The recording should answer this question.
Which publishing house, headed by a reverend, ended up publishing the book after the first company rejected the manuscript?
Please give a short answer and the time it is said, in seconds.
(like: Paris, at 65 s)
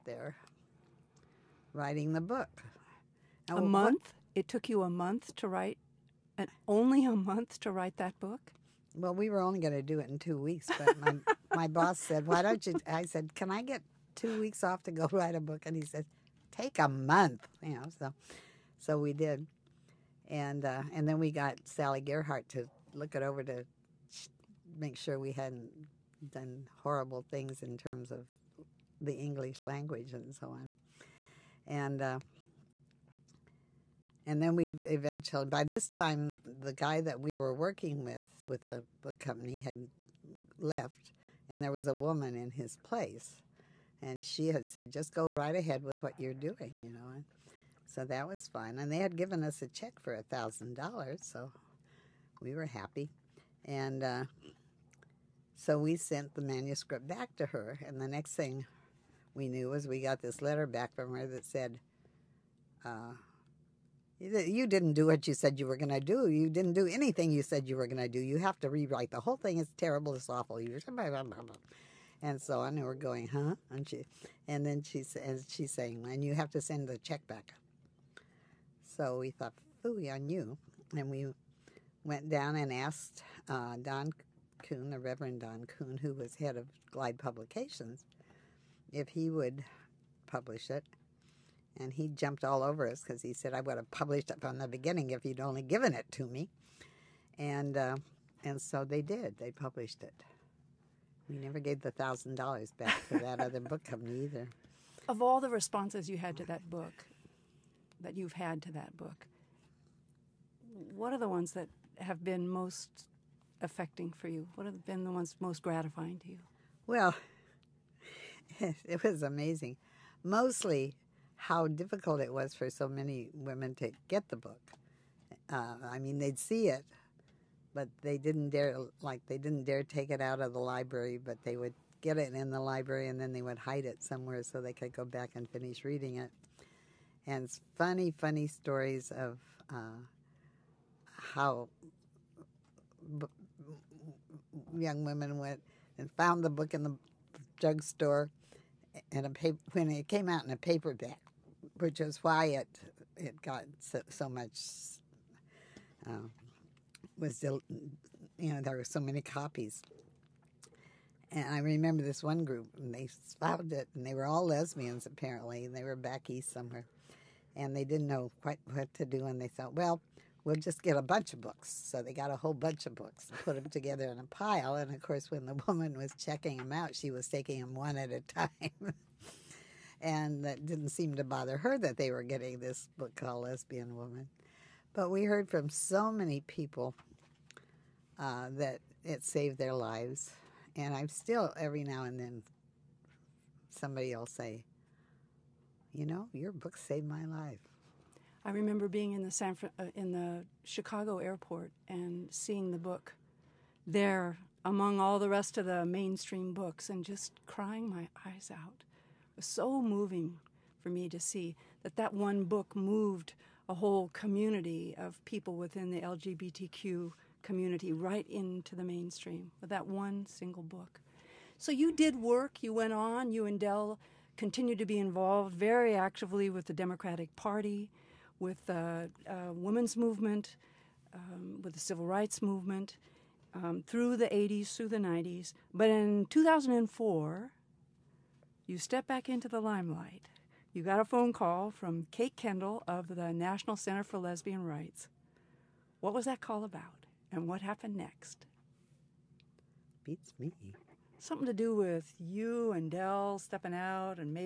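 Glide Publications, at 86 s.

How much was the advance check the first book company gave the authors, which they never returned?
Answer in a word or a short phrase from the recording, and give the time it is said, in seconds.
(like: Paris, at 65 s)
$1,000, at 50 s.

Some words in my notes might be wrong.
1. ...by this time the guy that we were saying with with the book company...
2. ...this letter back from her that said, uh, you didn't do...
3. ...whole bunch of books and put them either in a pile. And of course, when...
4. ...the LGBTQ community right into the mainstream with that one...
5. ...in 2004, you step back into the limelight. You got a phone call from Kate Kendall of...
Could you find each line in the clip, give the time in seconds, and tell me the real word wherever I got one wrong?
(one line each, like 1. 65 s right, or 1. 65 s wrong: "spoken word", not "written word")
1. 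35 s wrong: "working", not "saying"
2. 60 s right
3. 172 s wrong: "together", not "either"
4. 215 s right
5. 235 s right.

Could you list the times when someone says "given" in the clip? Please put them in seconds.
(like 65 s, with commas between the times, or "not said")
49 s, 95 s.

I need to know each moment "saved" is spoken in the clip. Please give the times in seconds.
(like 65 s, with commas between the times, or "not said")
189 s, 196 s.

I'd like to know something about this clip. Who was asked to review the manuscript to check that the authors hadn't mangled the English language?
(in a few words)
Sally Gearhart.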